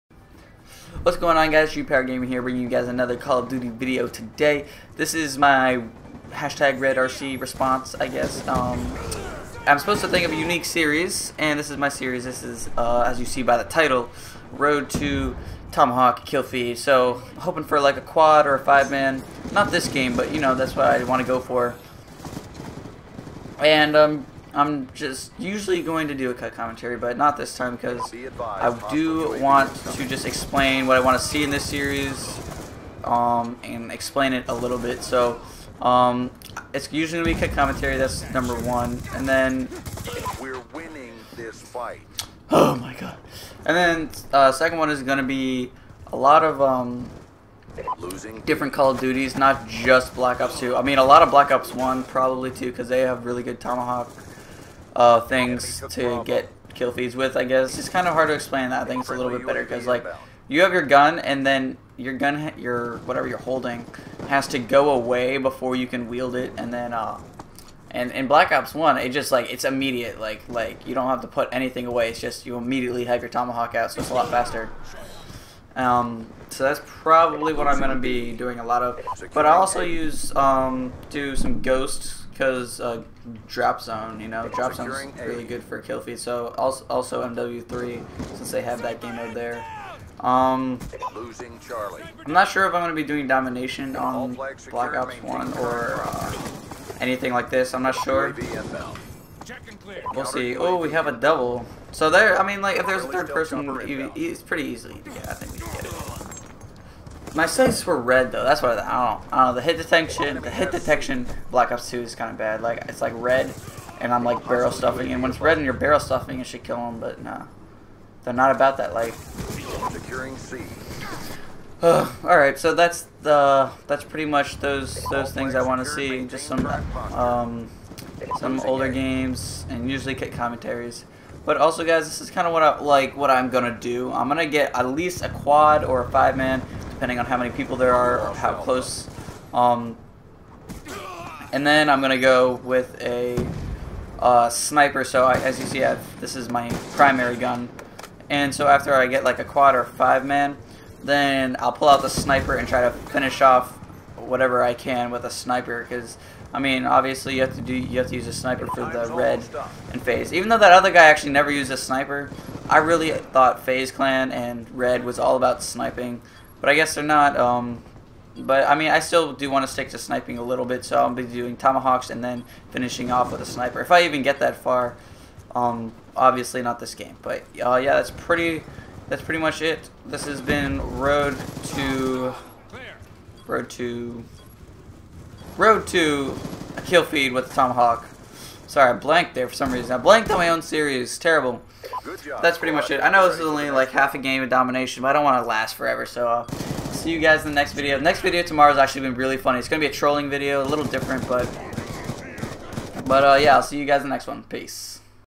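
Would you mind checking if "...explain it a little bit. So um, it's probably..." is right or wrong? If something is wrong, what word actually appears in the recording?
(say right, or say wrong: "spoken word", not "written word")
wrong: "usually", not "probably".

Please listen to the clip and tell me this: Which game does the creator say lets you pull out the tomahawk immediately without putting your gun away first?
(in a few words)
Black Ops 1.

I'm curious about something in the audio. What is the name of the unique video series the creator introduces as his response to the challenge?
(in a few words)
Road to Tomahawk Kill Feed.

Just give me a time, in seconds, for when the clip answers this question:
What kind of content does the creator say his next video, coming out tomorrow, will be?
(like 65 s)
199 s.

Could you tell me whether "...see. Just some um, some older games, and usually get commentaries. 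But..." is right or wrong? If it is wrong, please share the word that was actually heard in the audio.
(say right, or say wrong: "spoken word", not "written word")
right.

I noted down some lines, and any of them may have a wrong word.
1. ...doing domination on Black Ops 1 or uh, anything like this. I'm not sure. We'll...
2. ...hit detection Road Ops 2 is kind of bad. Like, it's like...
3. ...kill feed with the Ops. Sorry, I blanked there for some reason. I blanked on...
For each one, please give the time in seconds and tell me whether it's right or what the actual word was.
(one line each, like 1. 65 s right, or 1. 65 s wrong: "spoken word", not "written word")
1. 93 s right
2. 110 s wrong: "Black", not "Road"
3. 186 s wrong: "Tomahawk", not "Ops".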